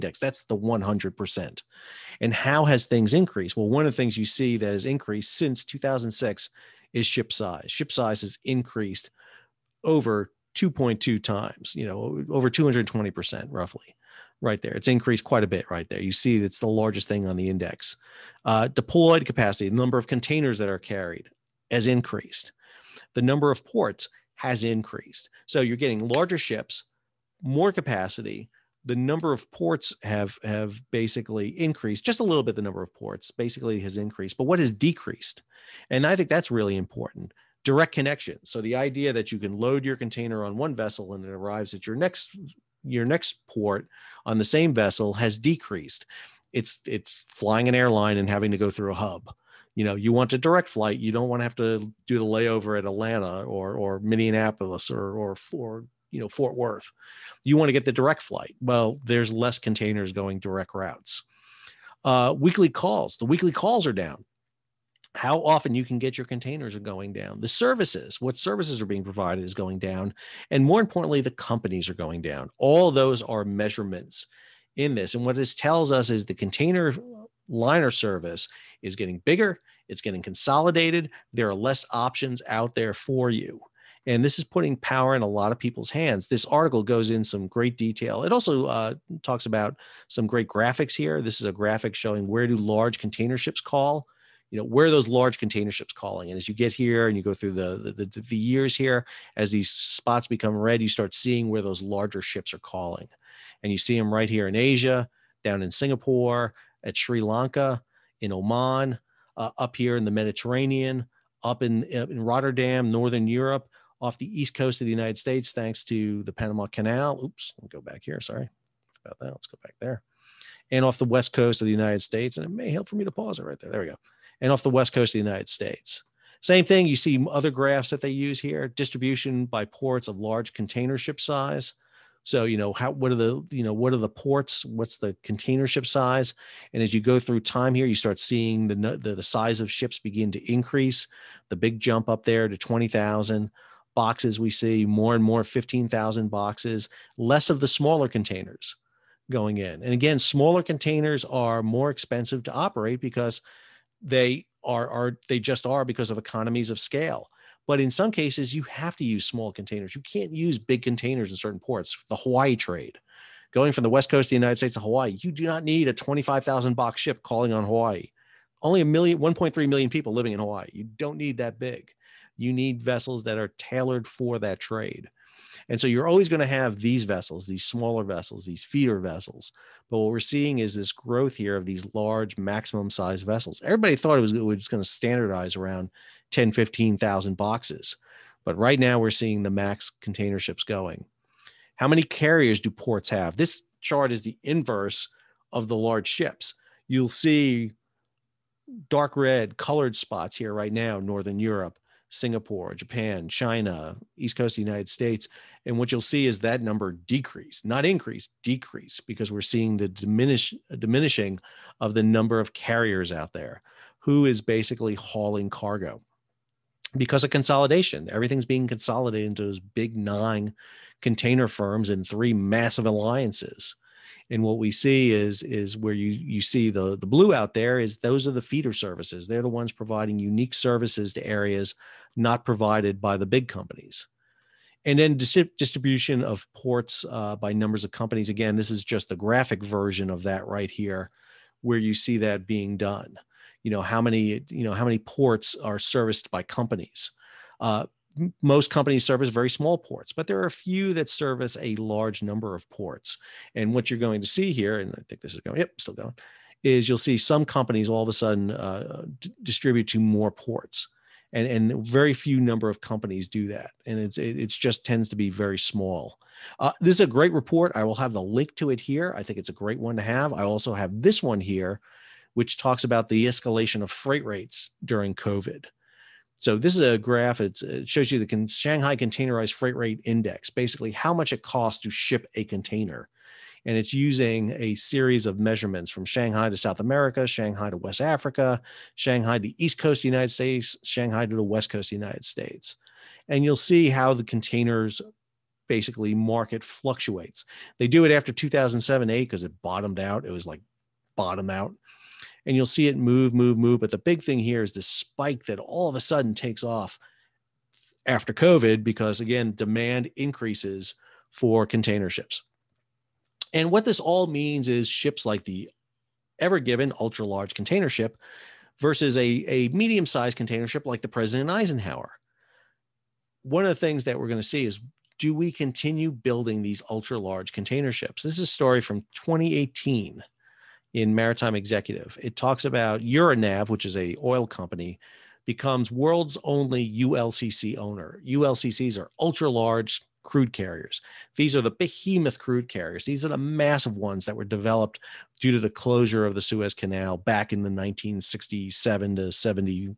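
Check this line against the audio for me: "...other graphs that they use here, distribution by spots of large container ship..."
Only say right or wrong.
wrong.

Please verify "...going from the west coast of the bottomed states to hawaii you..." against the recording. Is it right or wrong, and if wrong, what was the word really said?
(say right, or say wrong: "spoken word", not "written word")
wrong: "united", not "bottomed".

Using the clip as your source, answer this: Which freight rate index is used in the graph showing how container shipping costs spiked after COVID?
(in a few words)
Shanghai Containerized Freight Rate Index.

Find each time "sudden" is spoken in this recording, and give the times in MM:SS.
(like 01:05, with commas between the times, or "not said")
04:18, 05:05.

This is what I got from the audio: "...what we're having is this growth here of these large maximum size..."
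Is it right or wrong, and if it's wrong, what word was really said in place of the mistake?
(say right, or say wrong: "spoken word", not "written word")
wrong: "seeing", not "having".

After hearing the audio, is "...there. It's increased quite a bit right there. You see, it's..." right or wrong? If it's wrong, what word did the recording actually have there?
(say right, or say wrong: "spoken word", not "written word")
right.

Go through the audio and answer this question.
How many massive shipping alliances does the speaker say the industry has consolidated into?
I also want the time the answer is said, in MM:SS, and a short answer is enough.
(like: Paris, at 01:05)
3, at 03:42.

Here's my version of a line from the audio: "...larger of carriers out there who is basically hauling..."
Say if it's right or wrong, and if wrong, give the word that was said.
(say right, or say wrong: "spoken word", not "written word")
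wrong: "number", not "larger".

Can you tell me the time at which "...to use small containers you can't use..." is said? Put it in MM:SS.
02:38.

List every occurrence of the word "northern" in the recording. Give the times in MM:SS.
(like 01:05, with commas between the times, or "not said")
01:52, 03:20.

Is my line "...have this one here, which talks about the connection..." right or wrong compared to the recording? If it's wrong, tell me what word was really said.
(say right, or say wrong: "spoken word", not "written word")
wrong: "escalation", not "connection".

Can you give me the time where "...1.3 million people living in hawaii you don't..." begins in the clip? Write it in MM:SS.
02:49.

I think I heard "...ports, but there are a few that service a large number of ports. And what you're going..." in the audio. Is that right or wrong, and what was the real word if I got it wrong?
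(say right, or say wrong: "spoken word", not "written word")
right.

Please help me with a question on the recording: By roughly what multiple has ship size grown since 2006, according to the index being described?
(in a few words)
2.2 times.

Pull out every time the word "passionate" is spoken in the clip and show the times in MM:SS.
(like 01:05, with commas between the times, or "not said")
not said.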